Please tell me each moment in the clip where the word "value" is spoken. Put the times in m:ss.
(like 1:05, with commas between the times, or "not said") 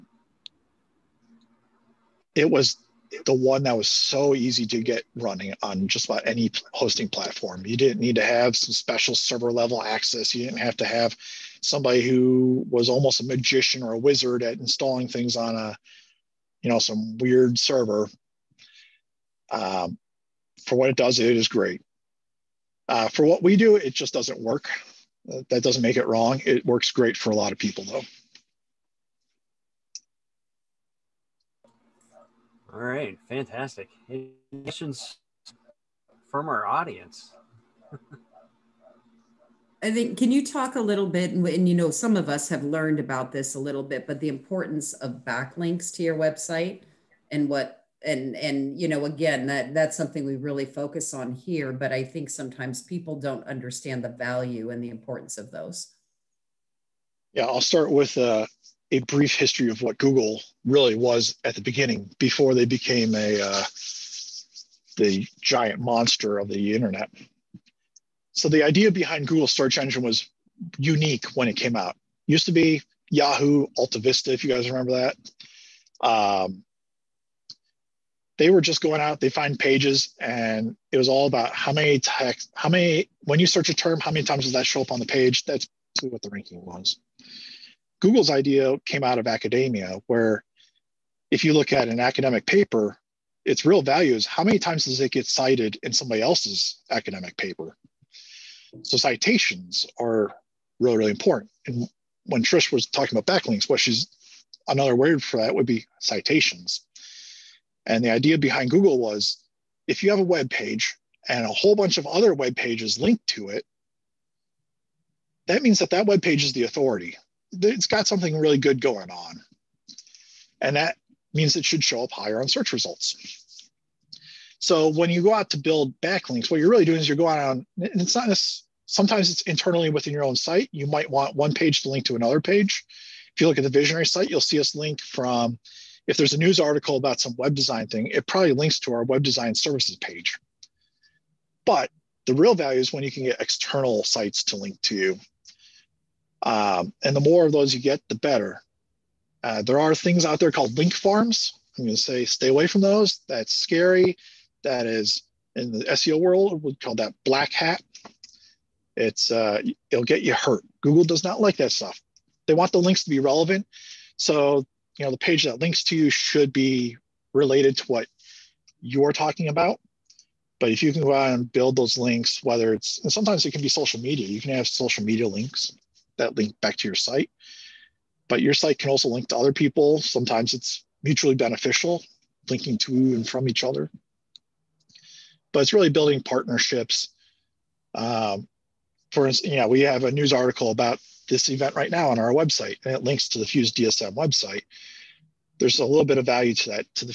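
0:54, 1:33, 2:22, 3:16.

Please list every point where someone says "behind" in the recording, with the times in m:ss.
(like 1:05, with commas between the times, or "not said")
1:08, 1:48.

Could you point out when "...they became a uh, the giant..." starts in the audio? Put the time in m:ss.
1:02.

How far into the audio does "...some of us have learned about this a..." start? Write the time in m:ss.
0:41.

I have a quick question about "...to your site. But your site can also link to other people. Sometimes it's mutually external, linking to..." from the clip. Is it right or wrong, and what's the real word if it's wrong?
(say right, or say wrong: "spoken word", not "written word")
wrong: "beneficial", not "external".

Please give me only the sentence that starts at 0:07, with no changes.
You didn't need to have some special server level access.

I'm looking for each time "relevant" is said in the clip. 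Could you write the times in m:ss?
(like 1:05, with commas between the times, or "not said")
2:43.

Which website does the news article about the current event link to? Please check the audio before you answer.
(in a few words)
Fuse DSM.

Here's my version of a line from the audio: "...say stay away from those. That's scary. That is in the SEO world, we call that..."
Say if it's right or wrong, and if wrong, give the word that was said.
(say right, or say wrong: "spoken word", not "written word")
right.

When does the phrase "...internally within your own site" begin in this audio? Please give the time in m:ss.
2:09.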